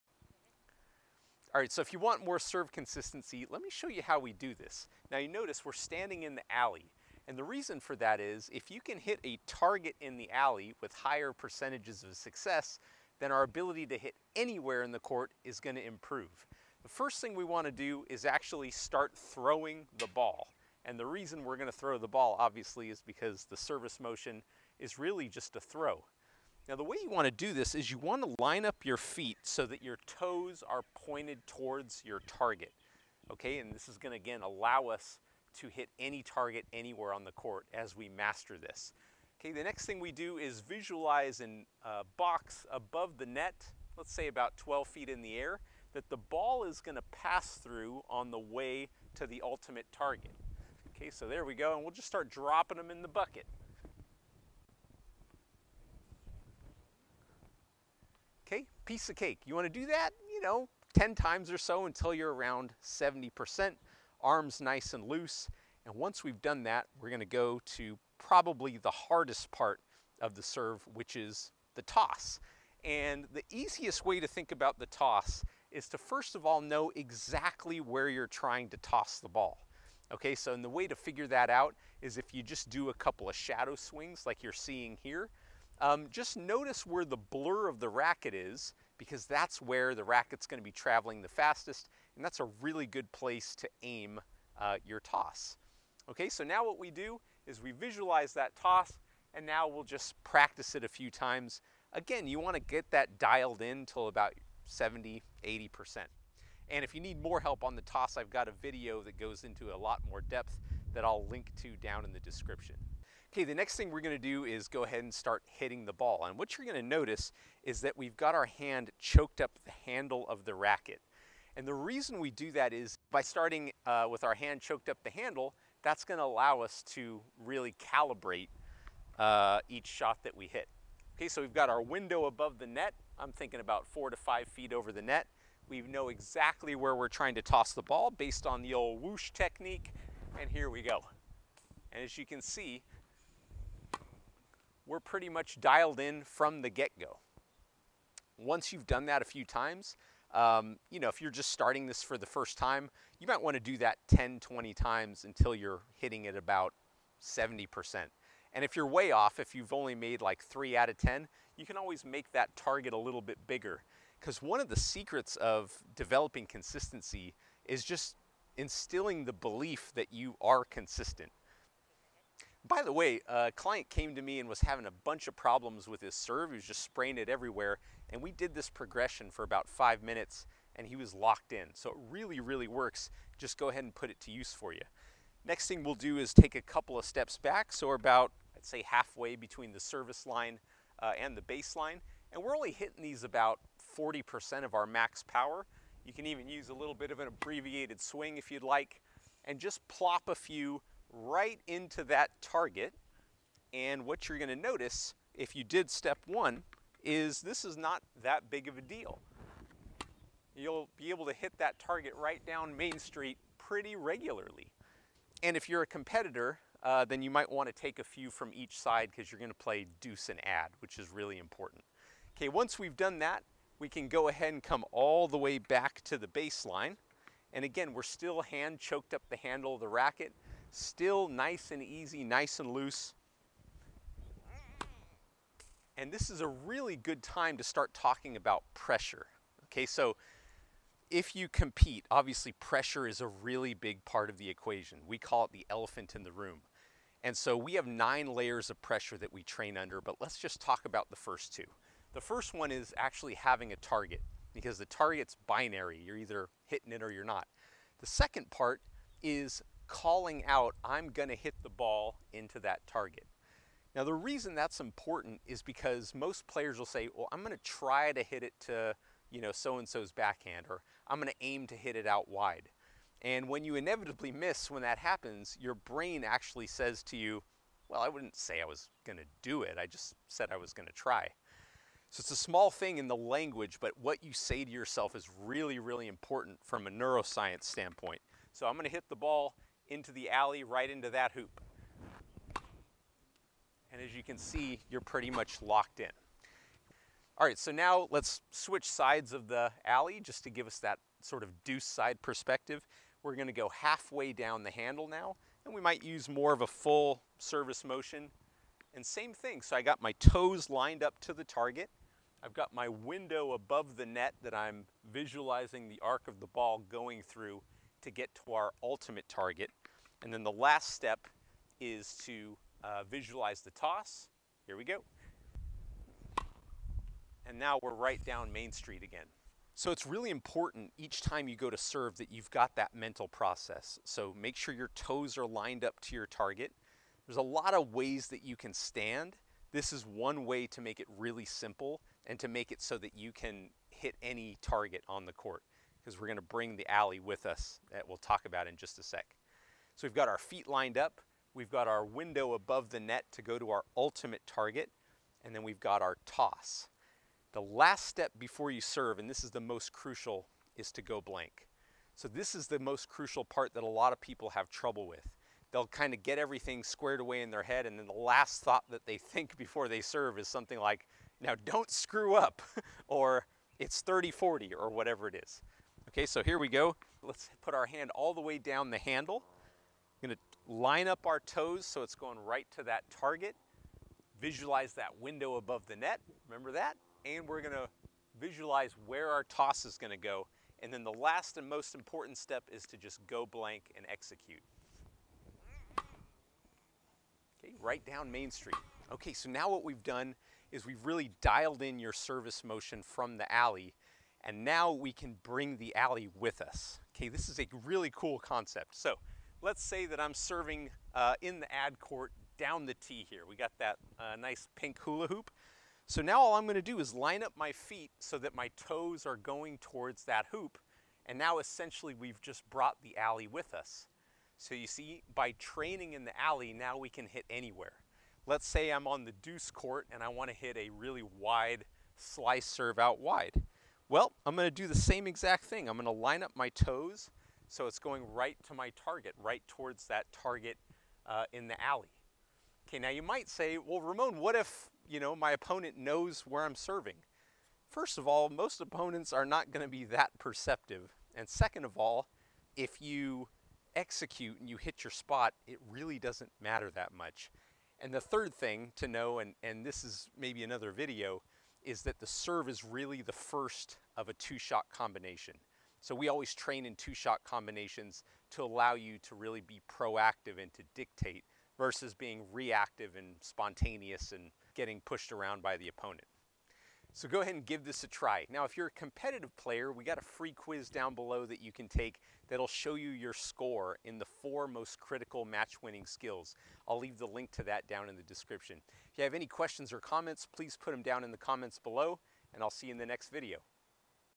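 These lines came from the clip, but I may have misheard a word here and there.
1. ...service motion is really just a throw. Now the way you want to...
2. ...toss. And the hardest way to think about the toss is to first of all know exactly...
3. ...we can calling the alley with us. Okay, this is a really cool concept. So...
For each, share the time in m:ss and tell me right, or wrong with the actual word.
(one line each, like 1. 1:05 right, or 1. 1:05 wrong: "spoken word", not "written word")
1. 0:23 right
2. 1:11 wrong: "easiest", not "hardest"
3. 6:44 wrong: "bring", not "calling".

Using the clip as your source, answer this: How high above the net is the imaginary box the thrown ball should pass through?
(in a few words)
12 feet.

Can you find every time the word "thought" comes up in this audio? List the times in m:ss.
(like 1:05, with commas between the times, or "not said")
6:08.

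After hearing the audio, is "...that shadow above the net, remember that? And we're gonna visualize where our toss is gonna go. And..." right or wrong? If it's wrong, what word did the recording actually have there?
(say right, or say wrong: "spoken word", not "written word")
wrong: "window", not "shadow".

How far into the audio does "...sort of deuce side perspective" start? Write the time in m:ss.
5:01.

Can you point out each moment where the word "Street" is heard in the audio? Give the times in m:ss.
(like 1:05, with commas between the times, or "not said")
3:32, 5:28, 6:38.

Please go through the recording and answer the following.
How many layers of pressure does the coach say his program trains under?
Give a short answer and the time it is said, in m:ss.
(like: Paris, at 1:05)
9, at 4:07.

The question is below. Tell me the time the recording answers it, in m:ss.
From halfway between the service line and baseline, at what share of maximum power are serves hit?
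3:13.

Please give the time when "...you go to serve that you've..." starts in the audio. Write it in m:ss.
5:31.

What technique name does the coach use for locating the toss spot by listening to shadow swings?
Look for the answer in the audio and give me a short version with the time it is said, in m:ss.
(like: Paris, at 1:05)
whoosh technique, at 2:19.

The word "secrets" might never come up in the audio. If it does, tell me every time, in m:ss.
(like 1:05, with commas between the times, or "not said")
2:44.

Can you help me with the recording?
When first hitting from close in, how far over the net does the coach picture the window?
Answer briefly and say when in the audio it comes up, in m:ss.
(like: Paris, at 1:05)
4 to 5 feet, at 2:13.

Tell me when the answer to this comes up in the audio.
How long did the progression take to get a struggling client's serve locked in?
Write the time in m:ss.
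2:59.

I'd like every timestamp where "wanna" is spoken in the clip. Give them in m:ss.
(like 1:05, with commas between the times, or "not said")
0:17, 0:59, 1:42, 7:10.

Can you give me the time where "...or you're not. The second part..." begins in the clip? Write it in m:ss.
4:17.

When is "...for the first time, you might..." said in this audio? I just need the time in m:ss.
2:32.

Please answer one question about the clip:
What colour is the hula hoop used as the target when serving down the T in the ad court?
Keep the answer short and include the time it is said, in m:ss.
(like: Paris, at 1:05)
pink, at 6:54.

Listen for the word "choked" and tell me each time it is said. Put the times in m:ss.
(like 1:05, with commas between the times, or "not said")
1:58, 2:04, 3:48.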